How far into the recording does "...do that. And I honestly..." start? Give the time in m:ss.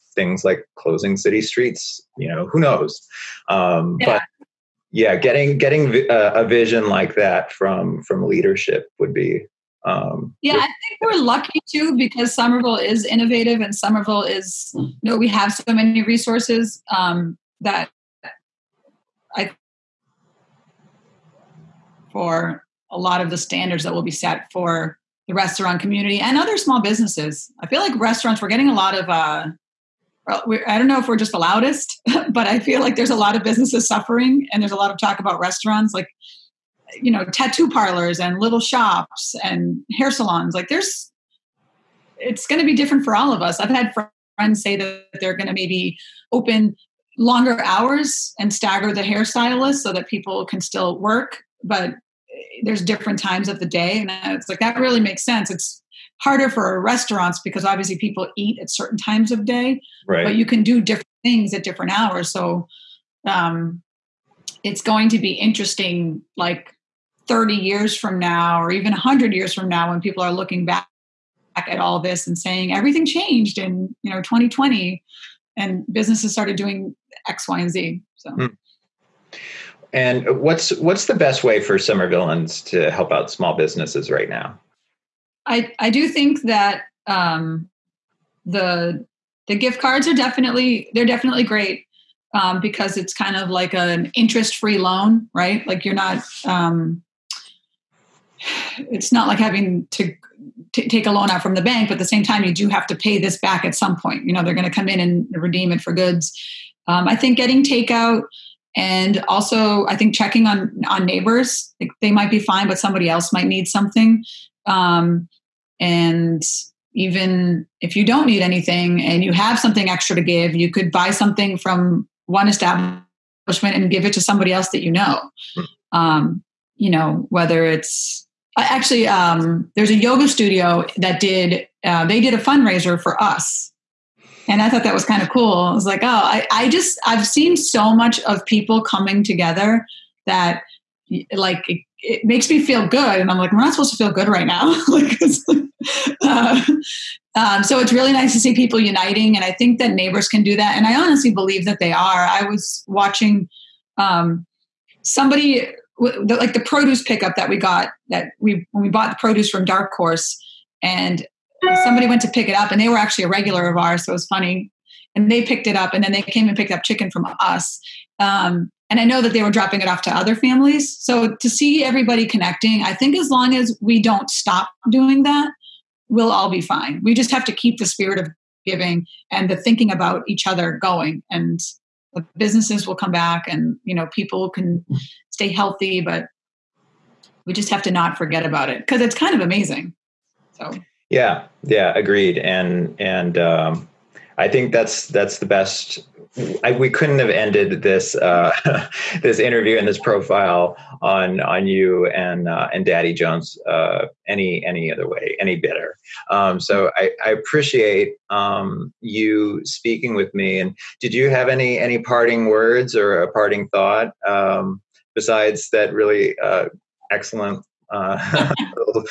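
2:30.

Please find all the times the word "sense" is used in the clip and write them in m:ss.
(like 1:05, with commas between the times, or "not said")
0:55.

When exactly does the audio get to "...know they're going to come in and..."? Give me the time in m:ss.
1:44.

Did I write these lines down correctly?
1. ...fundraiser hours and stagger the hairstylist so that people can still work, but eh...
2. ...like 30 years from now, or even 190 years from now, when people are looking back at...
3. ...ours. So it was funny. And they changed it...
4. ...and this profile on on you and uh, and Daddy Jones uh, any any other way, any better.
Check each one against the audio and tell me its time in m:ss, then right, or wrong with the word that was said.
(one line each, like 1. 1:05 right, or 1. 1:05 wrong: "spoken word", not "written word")
1. 0:47 wrong: "longer", not "fundraiser"
2. 1:06 wrong: "100", not "190"
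3. 2:43 wrong: "picked", not "changed"
4. 3:19 right.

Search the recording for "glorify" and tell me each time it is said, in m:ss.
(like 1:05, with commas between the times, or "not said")
not said.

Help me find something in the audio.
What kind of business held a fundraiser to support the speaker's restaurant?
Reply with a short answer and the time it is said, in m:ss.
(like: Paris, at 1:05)
yoga studio, at 2:09.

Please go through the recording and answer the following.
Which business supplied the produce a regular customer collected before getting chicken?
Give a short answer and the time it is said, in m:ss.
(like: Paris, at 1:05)
Dark Horse, at 2:39.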